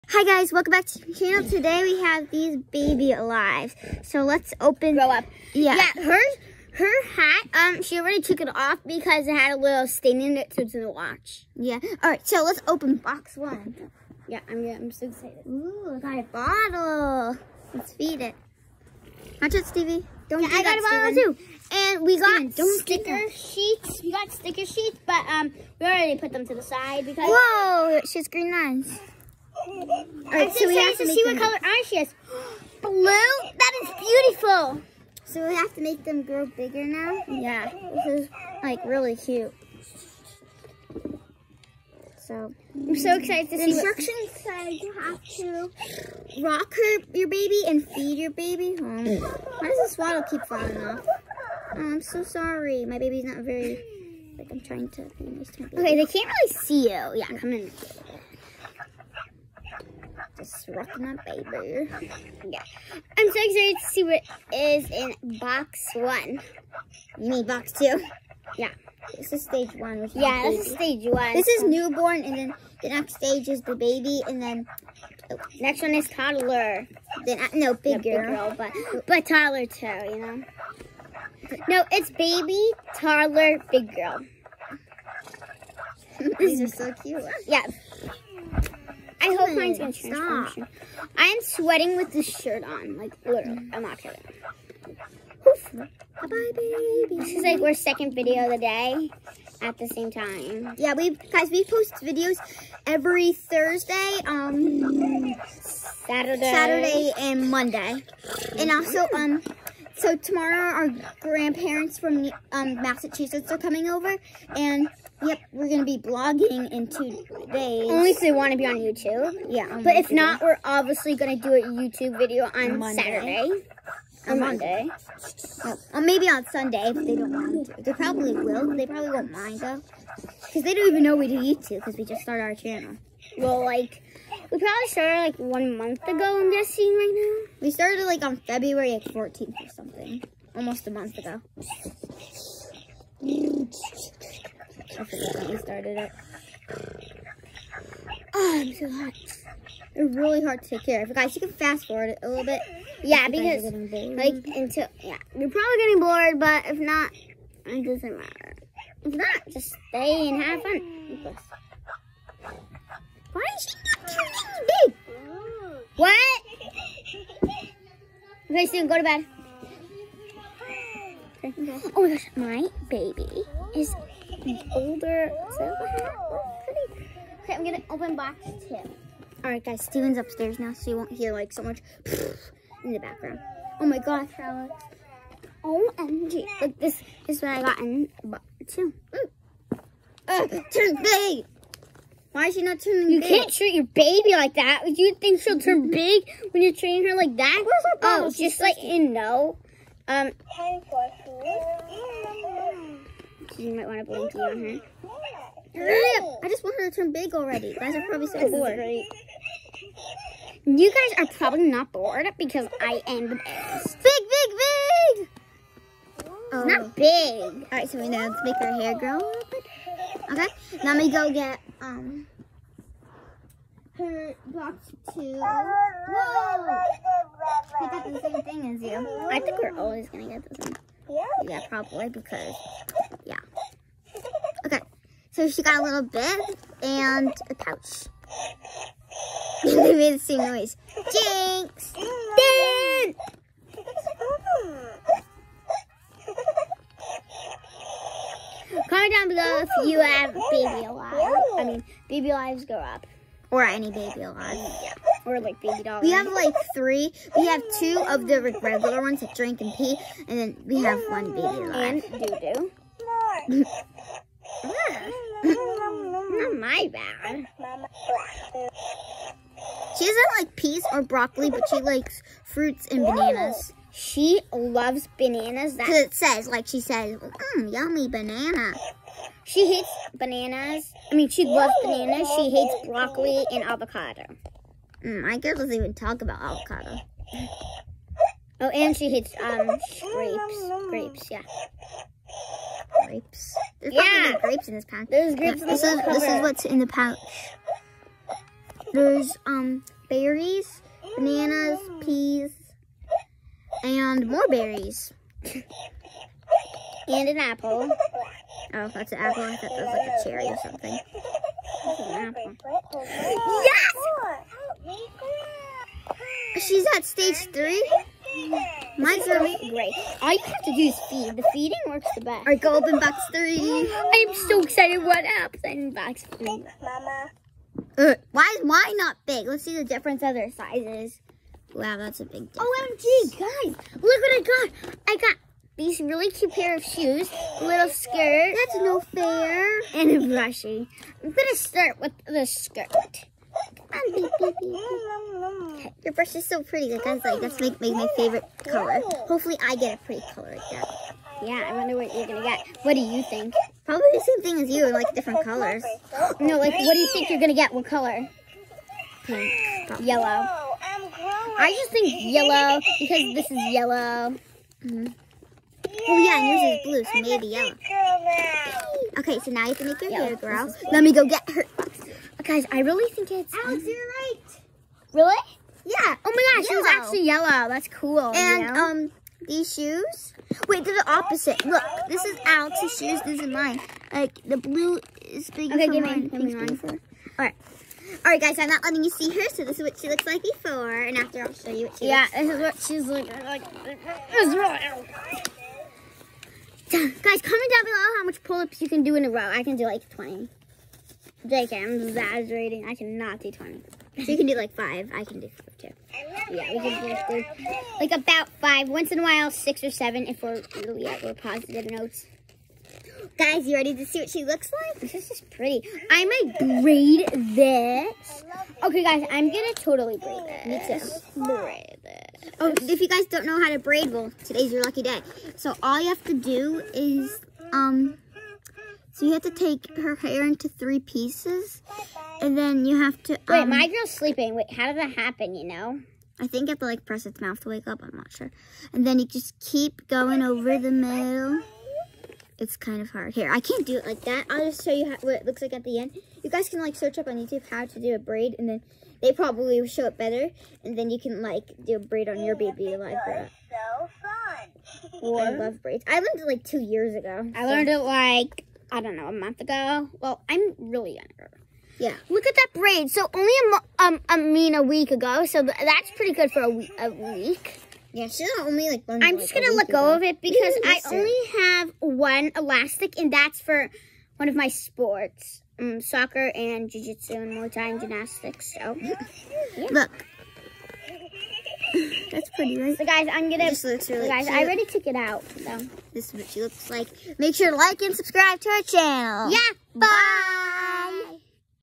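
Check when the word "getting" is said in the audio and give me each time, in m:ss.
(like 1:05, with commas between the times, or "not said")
2:35.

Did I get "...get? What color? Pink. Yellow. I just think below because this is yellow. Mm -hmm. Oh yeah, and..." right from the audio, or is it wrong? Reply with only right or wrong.
wrong.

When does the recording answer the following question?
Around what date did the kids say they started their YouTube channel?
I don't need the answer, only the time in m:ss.
2:18.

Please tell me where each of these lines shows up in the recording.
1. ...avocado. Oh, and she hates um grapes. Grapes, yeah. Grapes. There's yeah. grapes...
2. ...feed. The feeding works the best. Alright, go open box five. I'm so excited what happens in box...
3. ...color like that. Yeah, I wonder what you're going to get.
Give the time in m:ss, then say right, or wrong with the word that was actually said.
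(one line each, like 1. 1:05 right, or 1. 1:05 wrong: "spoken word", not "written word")
1. 4:46 right
2. 5:21 wrong: "three", not "five"
3. 5:50 right.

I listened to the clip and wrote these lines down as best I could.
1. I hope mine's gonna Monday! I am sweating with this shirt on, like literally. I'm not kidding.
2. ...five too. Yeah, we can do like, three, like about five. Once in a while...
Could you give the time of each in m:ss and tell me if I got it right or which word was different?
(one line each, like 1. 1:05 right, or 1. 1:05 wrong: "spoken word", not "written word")
1. 1:29 wrong: "Stop", not "Monday"
2. 6:45 right.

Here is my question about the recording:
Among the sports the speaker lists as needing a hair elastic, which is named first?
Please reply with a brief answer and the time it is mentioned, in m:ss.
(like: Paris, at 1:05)
Soccer, at 7:56.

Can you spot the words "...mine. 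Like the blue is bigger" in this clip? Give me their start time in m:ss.
6:23.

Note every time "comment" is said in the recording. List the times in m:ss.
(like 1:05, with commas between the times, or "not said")
4:08, 6:37.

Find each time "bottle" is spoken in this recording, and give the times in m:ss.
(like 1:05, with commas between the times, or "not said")
0:16, 0:21.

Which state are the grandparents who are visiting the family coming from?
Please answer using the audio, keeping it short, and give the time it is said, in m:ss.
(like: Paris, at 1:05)
Massachusetts, at 1:52.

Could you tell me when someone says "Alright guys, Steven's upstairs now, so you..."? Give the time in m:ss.
2:59.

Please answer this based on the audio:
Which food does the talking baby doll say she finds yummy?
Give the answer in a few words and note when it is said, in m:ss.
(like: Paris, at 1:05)
Banana, at 4:37.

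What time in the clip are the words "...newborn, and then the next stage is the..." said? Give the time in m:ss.
1:11.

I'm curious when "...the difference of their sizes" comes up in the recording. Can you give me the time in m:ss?
5:29.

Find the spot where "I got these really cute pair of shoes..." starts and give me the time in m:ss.
5:35.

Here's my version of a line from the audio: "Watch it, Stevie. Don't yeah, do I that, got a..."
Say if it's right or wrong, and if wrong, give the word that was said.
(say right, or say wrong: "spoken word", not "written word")
right.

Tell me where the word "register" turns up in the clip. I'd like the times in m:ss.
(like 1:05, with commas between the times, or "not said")
not said.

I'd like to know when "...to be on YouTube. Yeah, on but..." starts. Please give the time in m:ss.
1:58.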